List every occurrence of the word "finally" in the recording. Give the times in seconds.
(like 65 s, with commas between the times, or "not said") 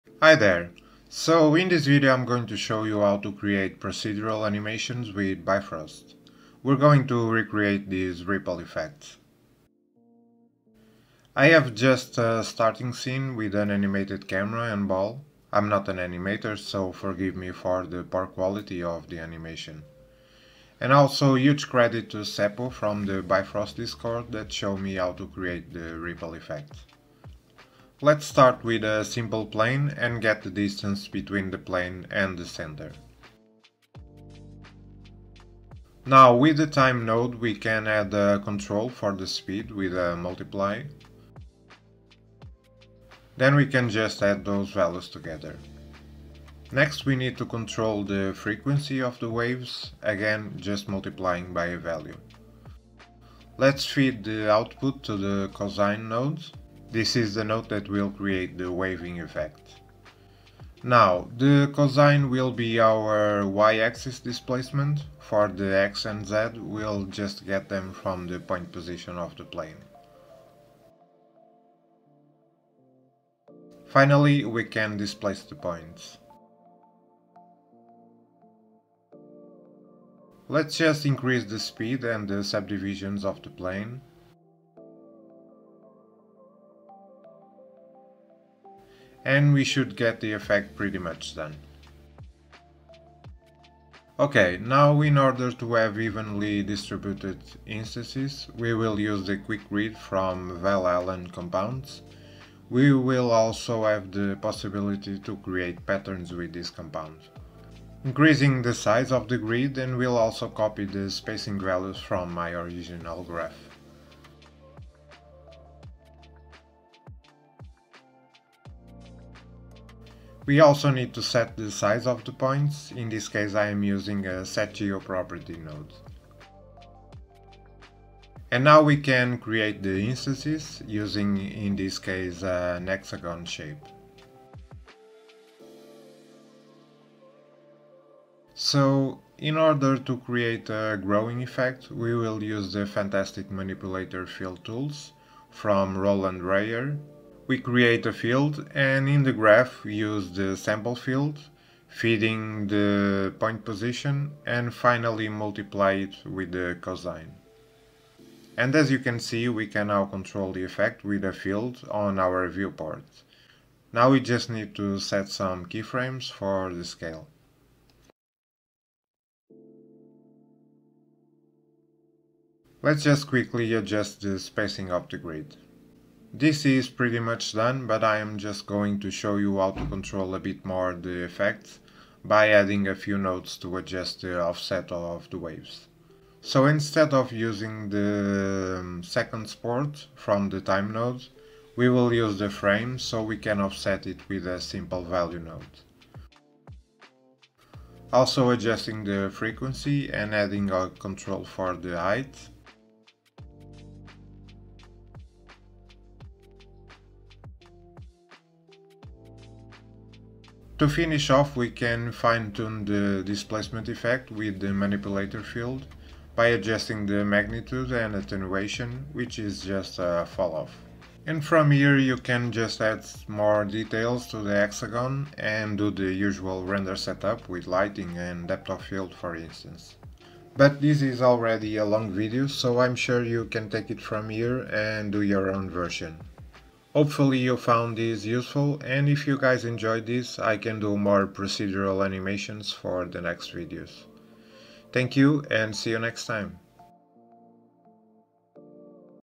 73 s, 154 s.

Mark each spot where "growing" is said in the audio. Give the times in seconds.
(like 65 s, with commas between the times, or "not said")
141 s.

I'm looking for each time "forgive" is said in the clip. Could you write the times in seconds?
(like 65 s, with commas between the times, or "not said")
16 s.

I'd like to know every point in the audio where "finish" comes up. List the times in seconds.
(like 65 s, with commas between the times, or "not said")
210 s.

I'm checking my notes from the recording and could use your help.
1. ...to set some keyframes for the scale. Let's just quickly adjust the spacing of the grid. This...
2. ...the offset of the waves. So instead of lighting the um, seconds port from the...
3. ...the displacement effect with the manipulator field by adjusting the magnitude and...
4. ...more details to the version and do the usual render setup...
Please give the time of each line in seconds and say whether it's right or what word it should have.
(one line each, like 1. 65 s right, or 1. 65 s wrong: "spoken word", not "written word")
1. 164 s right
2. 184 s wrong: "using", not "lighting"
3. 212 s right
4. 223 s wrong: "hexagon", not "version".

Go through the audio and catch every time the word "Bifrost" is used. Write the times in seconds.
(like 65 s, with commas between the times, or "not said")
5 s, 23 s.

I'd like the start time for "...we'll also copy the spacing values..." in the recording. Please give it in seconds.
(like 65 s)
109 s.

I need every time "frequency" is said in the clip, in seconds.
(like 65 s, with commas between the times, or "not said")
48 s, 199 s.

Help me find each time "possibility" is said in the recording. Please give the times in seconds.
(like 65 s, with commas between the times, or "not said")
104 s.